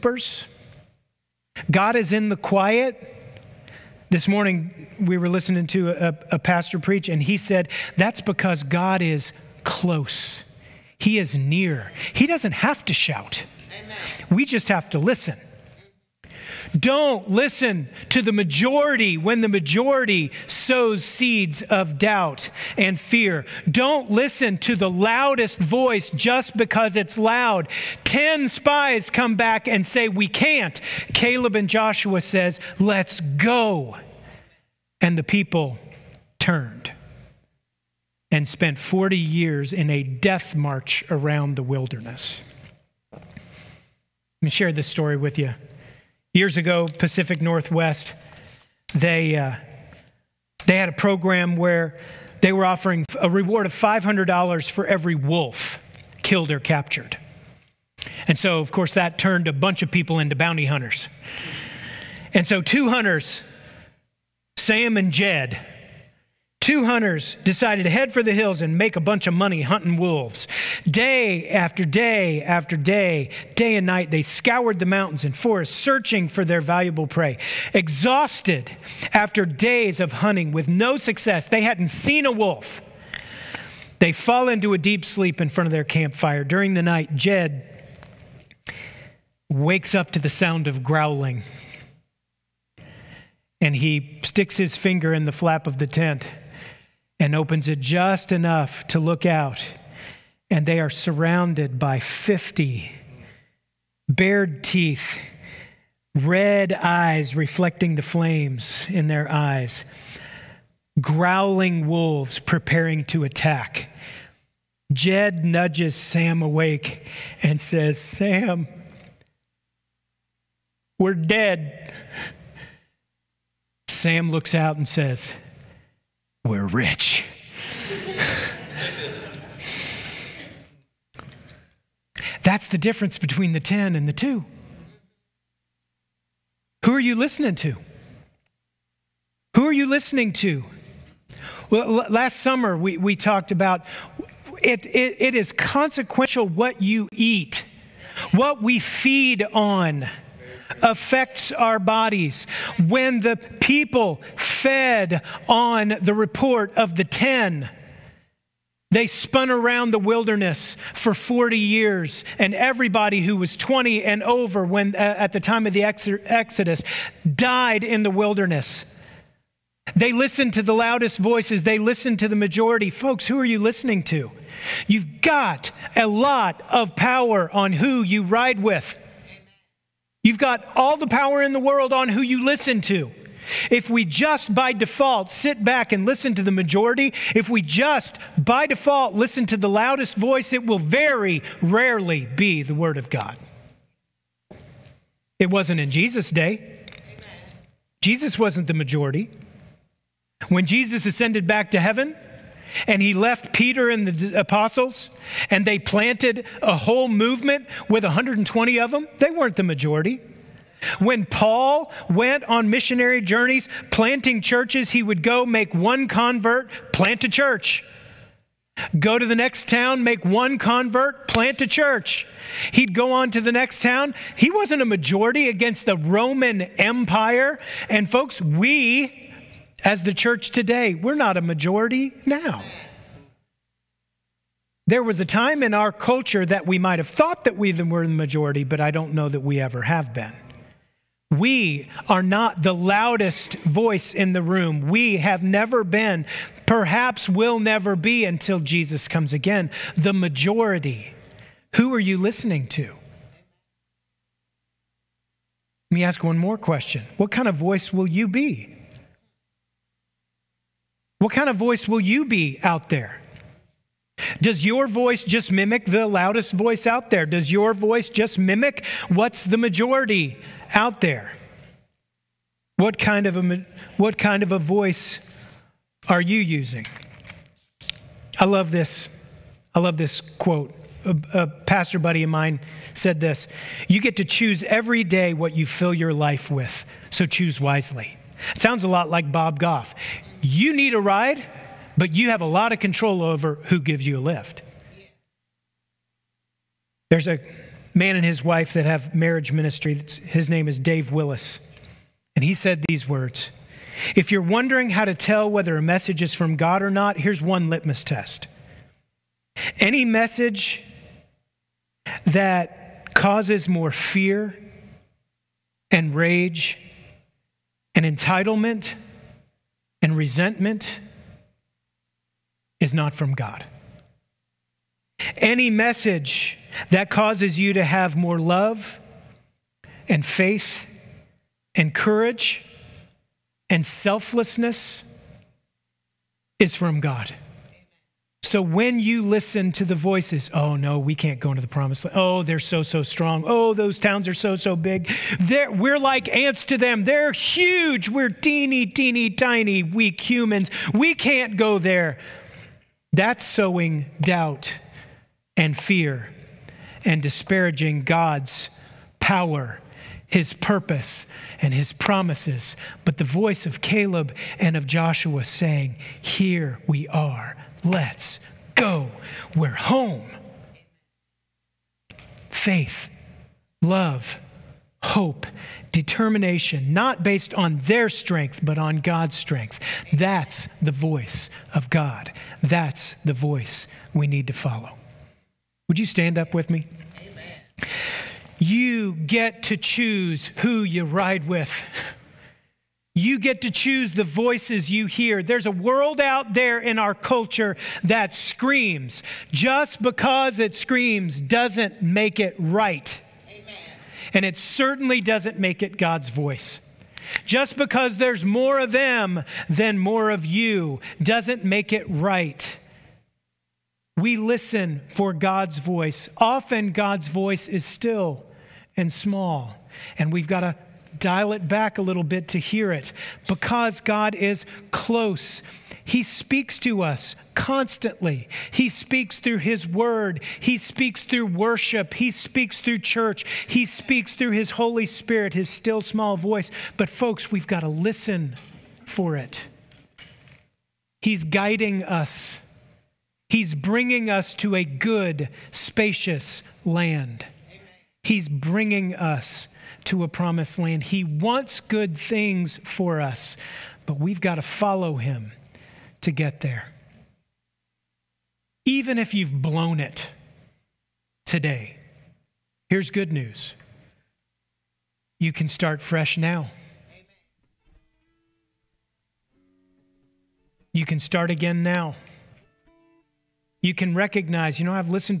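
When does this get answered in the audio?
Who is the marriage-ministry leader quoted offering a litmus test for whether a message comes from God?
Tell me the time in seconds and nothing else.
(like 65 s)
300 s.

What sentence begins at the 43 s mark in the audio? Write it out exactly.
Let me share this story with you.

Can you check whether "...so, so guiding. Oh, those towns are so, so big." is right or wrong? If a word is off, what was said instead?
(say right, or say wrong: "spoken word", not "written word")
wrong: "strong", not "guiding".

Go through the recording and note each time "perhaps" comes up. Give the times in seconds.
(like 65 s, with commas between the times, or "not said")
246 s.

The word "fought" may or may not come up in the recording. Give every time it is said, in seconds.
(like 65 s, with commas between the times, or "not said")
not said.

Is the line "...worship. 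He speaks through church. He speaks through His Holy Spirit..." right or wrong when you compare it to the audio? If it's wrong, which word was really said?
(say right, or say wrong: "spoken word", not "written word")
right.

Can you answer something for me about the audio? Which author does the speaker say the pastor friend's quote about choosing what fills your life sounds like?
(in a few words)
Bob Goff.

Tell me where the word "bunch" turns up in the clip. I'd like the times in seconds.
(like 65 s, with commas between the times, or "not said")
59 s, 69 s.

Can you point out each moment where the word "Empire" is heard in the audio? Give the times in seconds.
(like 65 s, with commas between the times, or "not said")
226 s.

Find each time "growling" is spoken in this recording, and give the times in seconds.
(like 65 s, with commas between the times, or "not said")
90 s, 111 s.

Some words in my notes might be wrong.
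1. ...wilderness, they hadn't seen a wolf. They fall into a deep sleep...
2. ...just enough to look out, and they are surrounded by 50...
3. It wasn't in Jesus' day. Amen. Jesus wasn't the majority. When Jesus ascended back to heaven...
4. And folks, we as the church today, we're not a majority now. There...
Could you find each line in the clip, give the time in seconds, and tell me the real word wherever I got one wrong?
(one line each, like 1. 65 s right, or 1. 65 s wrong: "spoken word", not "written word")
1. 80 s wrong: "success", not "wilderness"
2. 97 s right
3. 195 s right
4. 227 s right.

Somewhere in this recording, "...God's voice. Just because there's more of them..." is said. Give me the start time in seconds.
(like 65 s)
405 s.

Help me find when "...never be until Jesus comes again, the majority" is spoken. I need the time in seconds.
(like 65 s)
247 s.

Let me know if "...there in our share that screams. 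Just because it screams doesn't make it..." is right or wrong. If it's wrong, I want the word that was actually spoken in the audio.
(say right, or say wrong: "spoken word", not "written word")
wrong: "culture", not "share".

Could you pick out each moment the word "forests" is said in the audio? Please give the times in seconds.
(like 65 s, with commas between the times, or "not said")
75 s.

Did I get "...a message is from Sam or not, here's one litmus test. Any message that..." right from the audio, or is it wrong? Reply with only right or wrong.
wrong.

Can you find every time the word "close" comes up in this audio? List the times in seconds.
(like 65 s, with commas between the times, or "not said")
9 s, 424 s.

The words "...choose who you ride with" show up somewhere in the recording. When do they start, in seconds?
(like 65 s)
389 s.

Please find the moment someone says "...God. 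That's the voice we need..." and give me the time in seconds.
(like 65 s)
381 s.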